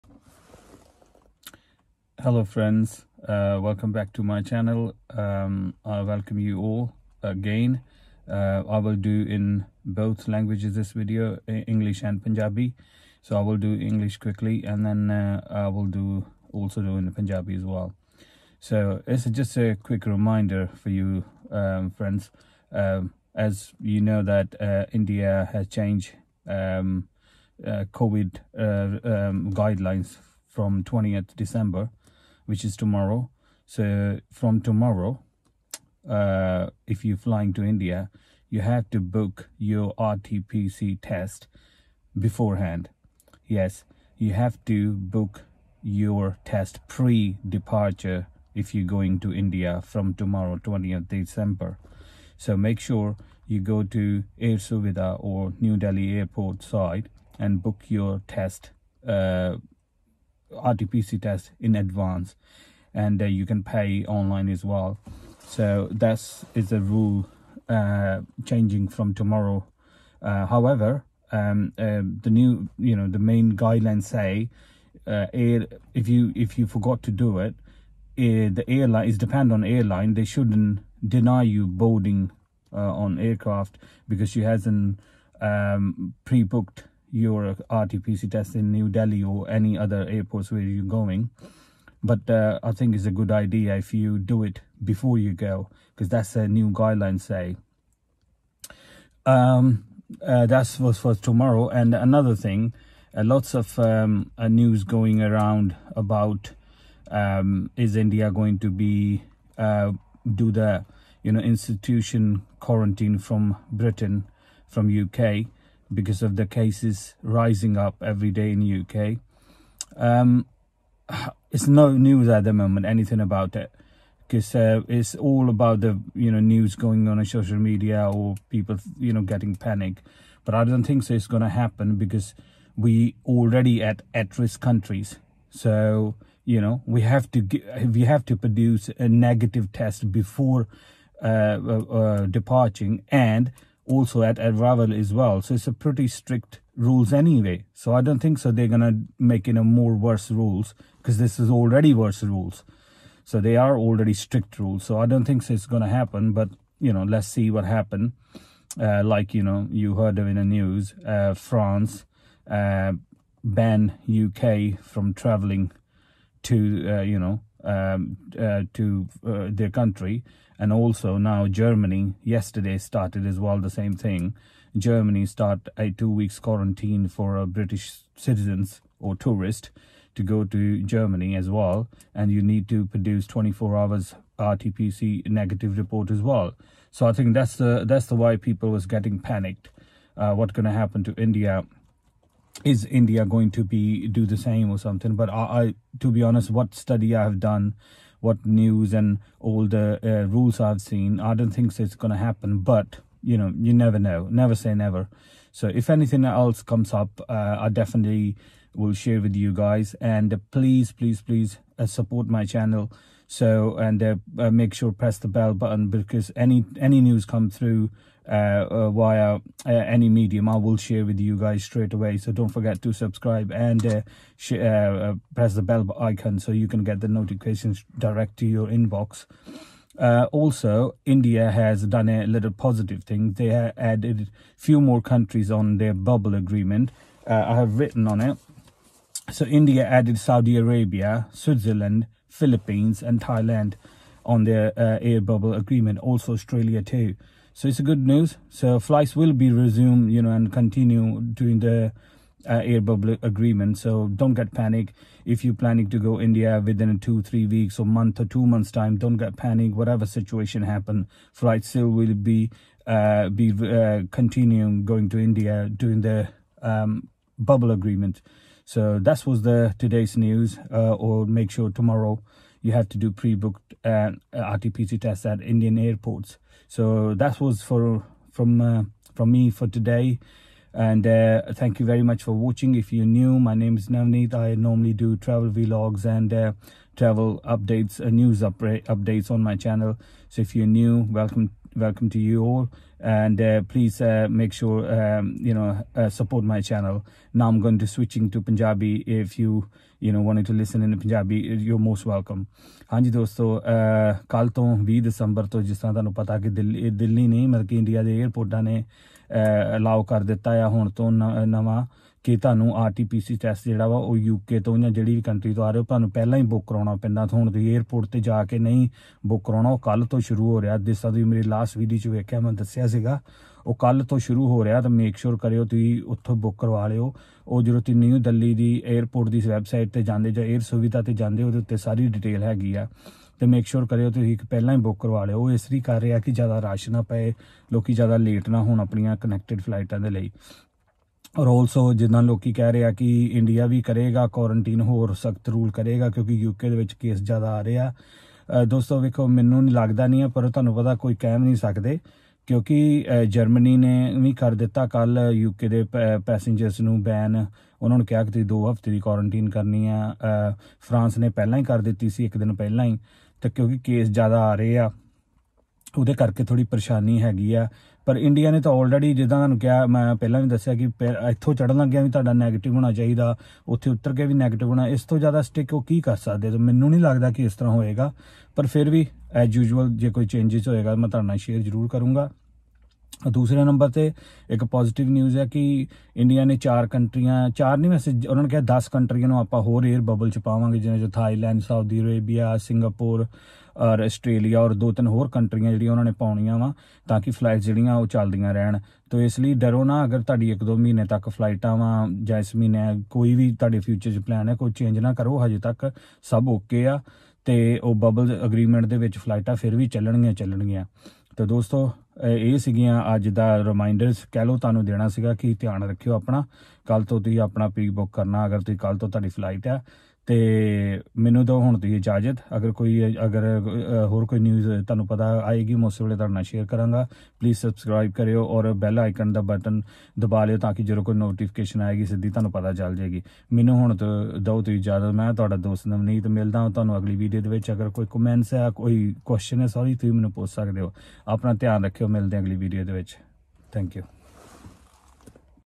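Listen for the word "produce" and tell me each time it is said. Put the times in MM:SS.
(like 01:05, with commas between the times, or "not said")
02:18, 03:02.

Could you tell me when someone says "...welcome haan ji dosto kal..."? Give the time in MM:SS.
05:02.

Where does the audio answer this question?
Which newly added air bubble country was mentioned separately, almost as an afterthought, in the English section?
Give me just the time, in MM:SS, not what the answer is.
04:06.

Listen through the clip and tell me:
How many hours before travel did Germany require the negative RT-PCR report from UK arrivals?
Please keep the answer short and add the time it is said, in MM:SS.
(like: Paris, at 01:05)
24 hours, at 03:03.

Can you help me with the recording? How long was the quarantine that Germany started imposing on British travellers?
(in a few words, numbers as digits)
two weeks.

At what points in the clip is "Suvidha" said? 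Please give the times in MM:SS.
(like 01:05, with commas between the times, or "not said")
00:54.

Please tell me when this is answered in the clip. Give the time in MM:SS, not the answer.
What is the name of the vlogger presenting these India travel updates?
04:43.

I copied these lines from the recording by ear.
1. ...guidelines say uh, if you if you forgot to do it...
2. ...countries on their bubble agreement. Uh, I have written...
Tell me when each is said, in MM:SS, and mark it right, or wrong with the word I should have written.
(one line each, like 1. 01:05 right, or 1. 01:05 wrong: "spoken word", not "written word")
1. 01:13 right
2. 03:55 right.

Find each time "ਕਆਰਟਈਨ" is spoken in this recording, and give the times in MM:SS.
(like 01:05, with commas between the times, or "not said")
05:44, 05:58.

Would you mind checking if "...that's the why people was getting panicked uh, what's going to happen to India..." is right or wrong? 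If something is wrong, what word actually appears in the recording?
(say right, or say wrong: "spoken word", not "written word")
right.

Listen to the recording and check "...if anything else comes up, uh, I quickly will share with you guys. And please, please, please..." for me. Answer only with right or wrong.
wrong.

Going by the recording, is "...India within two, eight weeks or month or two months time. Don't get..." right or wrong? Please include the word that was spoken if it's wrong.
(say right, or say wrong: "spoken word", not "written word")
wrong: "three", not "eight".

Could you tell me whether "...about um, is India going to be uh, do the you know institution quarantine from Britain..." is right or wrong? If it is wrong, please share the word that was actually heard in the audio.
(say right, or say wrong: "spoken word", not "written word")
right.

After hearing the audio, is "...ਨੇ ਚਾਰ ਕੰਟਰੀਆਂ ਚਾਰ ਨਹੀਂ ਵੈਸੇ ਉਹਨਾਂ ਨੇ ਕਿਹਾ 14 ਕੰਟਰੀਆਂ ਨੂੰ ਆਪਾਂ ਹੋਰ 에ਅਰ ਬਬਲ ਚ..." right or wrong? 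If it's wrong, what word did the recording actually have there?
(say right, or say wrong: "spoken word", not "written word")
wrong: "10", not "14".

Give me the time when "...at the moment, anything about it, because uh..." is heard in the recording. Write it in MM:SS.
02:02.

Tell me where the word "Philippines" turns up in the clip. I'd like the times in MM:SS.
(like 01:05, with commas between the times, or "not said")
04:02.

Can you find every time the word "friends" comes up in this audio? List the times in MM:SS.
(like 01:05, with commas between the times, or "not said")
00:02, 00:21.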